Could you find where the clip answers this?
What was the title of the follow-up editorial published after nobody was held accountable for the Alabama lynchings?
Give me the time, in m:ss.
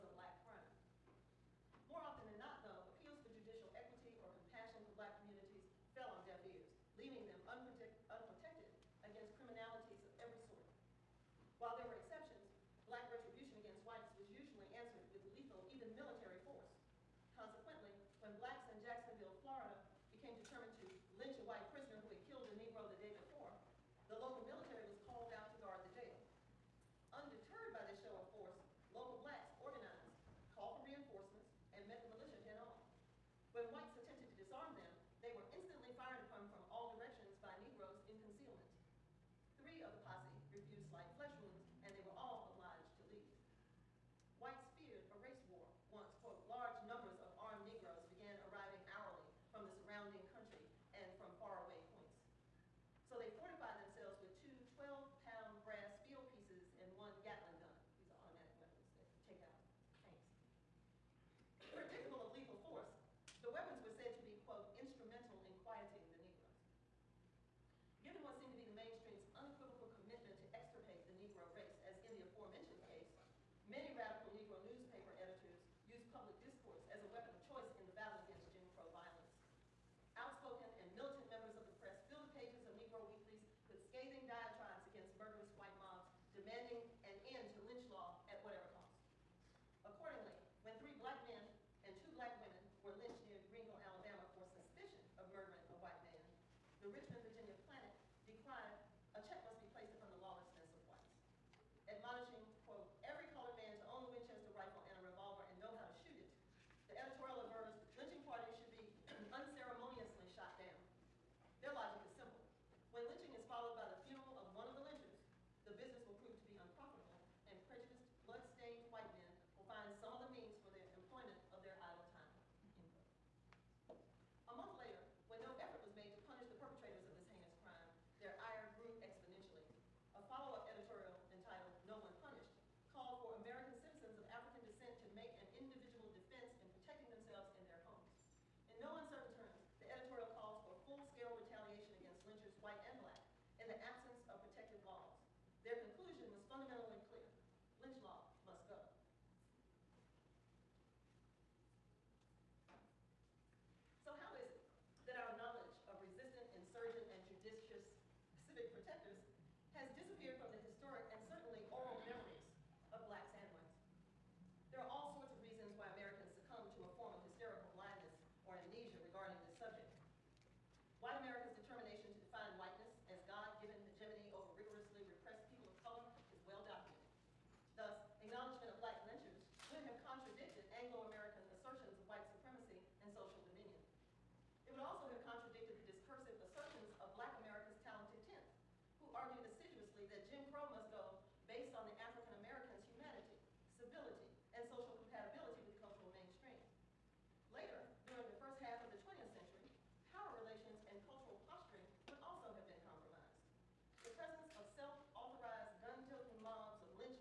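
2:11.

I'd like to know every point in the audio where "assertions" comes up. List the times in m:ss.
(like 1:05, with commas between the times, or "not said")
3:01, 3:06.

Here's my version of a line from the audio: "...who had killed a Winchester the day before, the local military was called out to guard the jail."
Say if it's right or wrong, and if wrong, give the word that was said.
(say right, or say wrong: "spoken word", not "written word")
wrong: "Negro", not "Winchester".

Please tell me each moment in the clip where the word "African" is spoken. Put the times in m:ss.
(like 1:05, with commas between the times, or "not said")
2:14, 3:11.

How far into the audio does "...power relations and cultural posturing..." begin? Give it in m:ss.
3:20.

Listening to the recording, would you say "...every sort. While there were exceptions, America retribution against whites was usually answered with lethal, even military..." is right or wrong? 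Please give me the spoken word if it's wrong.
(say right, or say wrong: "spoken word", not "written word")
wrong: "Black", not "America".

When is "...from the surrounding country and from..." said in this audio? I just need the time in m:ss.
0:49.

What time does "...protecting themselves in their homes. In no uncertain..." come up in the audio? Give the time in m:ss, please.
2:16.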